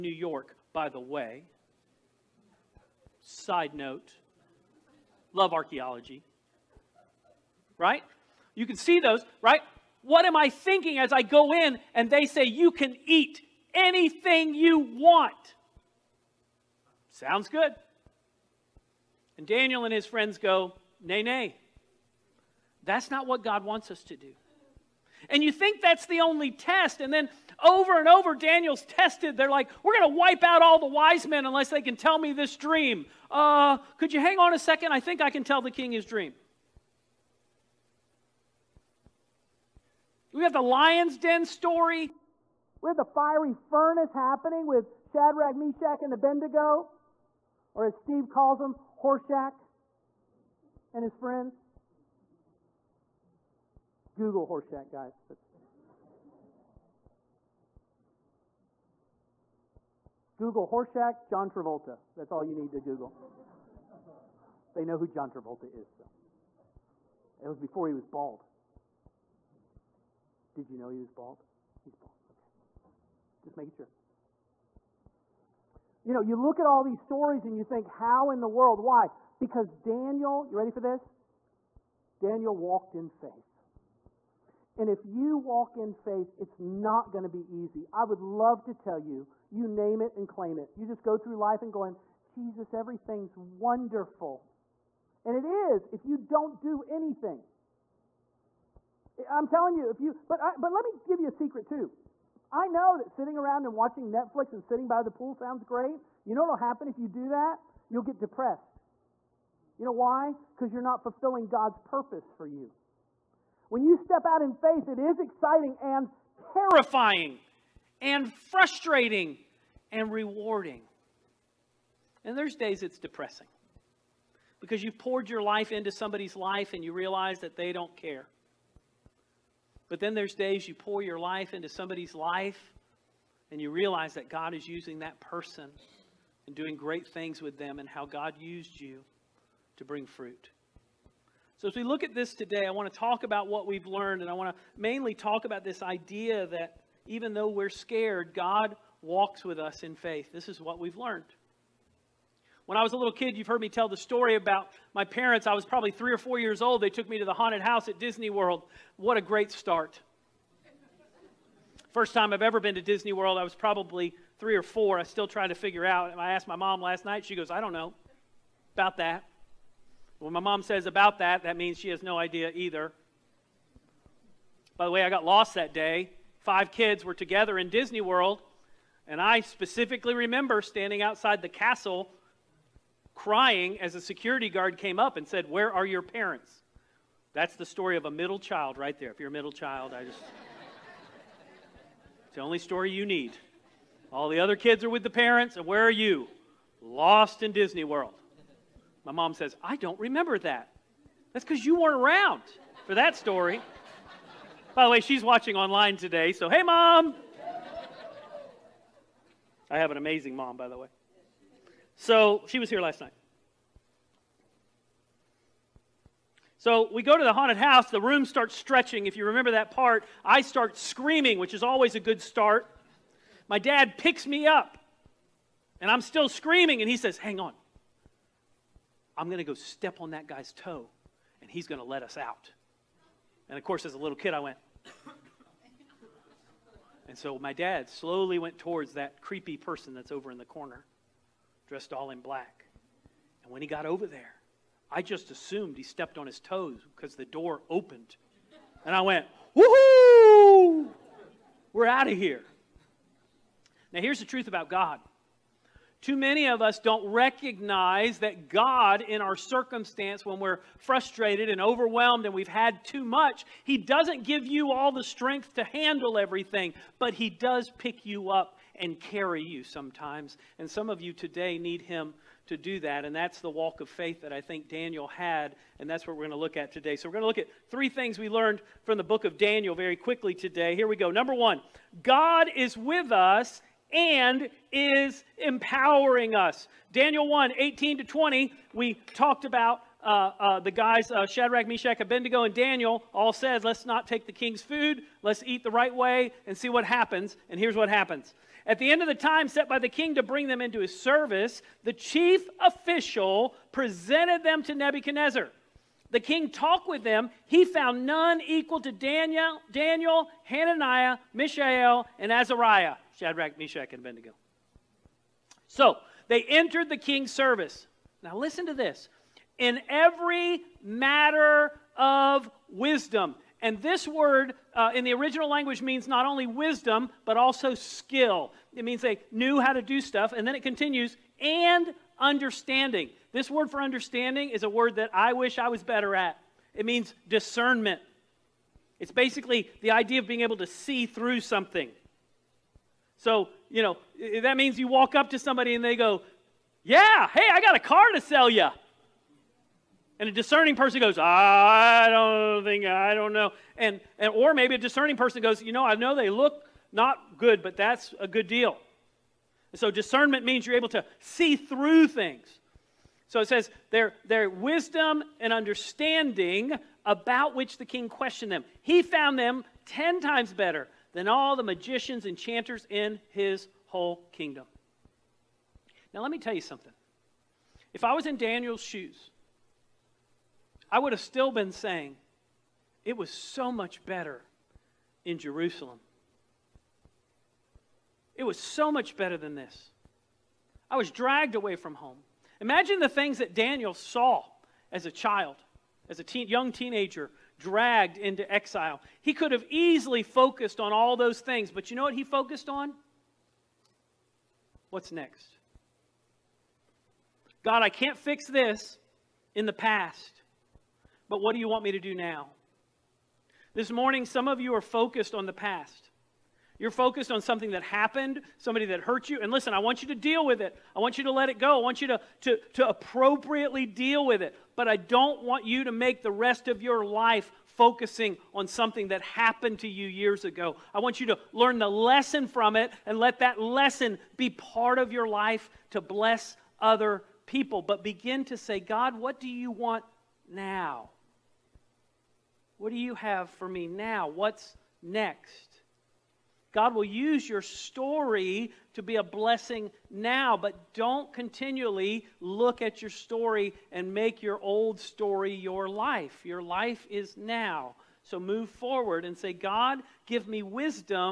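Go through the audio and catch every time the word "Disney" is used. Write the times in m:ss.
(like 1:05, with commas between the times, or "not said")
2:37, 2:42, 2:57, 3:17.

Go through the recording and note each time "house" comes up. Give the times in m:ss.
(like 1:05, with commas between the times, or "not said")
2:37, 3:37.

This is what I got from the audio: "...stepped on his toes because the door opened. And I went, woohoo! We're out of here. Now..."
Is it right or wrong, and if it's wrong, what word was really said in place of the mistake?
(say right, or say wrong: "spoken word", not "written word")
right.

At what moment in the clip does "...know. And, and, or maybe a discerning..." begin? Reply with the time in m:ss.
5:53.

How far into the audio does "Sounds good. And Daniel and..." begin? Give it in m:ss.
0:17.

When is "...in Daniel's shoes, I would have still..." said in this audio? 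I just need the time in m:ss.
6:18.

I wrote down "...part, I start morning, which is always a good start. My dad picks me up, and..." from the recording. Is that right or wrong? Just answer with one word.
wrong.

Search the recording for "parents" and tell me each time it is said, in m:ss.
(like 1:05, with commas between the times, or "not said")
2:35, 3:06, 3:15.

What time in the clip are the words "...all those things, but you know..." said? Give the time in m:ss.
6:40.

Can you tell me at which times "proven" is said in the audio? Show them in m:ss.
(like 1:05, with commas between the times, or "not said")
not said.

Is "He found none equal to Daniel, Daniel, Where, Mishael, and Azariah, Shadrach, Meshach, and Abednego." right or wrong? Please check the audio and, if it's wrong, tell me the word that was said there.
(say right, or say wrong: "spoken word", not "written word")
wrong: "Hananiah", not "Where".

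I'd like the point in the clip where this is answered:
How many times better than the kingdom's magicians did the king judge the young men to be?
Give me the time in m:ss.
6:09.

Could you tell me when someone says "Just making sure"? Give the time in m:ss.
1:13.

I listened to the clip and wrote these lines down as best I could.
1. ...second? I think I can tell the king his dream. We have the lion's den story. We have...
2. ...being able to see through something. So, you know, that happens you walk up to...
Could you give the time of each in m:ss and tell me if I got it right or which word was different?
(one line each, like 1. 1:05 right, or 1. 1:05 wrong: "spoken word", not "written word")
1. 0:34 right
2. 5:40 wrong: "means", not "happens".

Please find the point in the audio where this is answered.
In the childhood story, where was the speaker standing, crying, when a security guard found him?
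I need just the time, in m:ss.
3:01.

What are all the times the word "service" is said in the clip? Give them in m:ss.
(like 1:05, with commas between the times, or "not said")
5:00, 5:17.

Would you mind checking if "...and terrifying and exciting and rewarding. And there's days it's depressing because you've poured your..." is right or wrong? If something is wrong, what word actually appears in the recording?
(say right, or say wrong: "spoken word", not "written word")
wrong: "frustrating", not "exciting".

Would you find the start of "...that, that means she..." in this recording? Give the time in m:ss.
2:51.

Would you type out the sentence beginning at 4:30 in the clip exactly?
And some of you today need him to do that.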